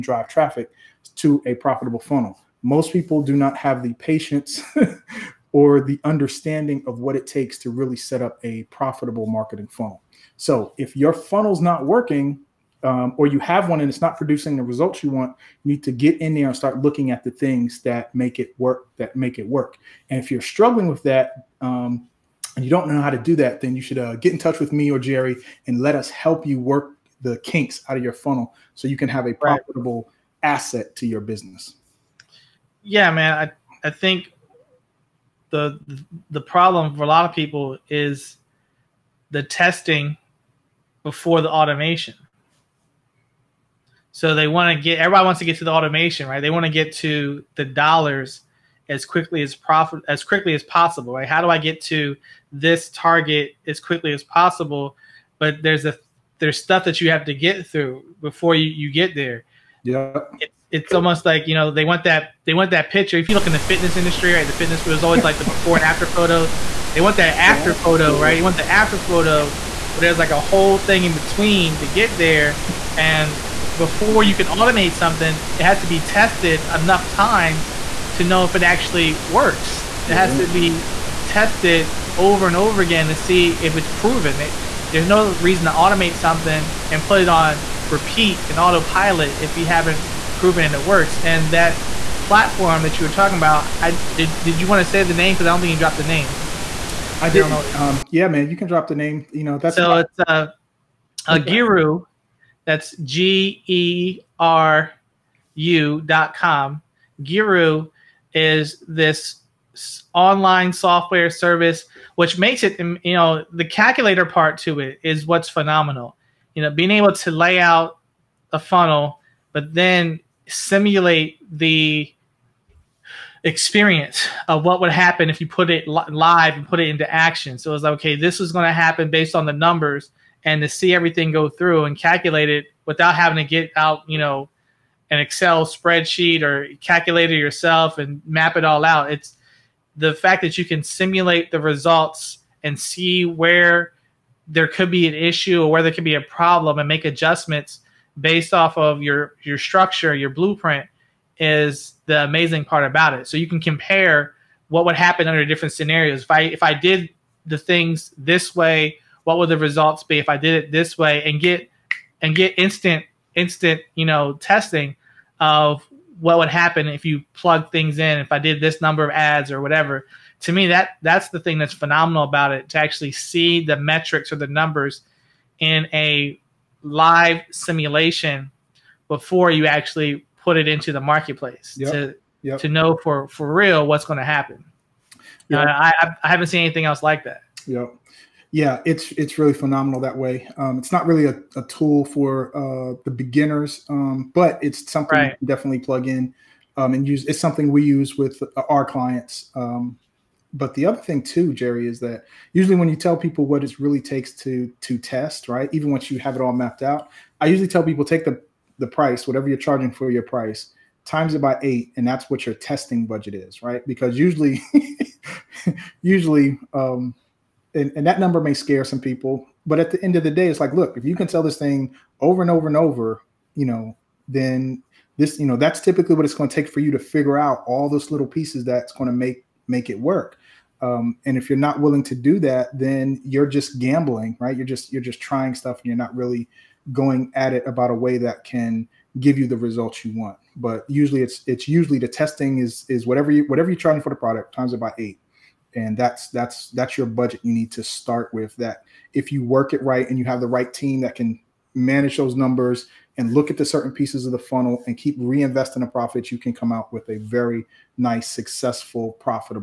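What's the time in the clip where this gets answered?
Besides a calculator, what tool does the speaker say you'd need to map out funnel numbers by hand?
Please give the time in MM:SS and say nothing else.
02:15.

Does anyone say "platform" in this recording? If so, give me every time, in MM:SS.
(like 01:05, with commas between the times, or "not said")
01:32.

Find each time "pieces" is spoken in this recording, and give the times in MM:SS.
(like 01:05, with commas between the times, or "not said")
03:48, 04:13.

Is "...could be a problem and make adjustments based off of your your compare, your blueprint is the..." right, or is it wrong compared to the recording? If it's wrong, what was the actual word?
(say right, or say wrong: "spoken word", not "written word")
wrong: "structure", not "compare".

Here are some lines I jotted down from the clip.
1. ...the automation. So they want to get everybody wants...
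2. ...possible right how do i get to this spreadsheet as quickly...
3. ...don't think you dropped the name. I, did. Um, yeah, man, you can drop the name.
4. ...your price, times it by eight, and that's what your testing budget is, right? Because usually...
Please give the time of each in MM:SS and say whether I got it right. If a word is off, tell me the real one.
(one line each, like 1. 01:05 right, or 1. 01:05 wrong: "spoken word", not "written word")
1. 00:41 right
2. 00:50 wrong: "target", not "spreadsheet"
3. 01:35 right
4. 03:30 right.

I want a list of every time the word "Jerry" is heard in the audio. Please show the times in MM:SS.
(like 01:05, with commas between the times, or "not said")
00:24, 03:21.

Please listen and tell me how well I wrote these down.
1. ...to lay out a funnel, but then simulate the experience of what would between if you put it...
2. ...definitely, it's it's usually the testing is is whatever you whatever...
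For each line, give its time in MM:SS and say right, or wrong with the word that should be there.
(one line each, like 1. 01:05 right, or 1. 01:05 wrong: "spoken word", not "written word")
1. 01:57 wrong: "happen", not "between"
2. 04:00 wrong: "usually", not "definitely".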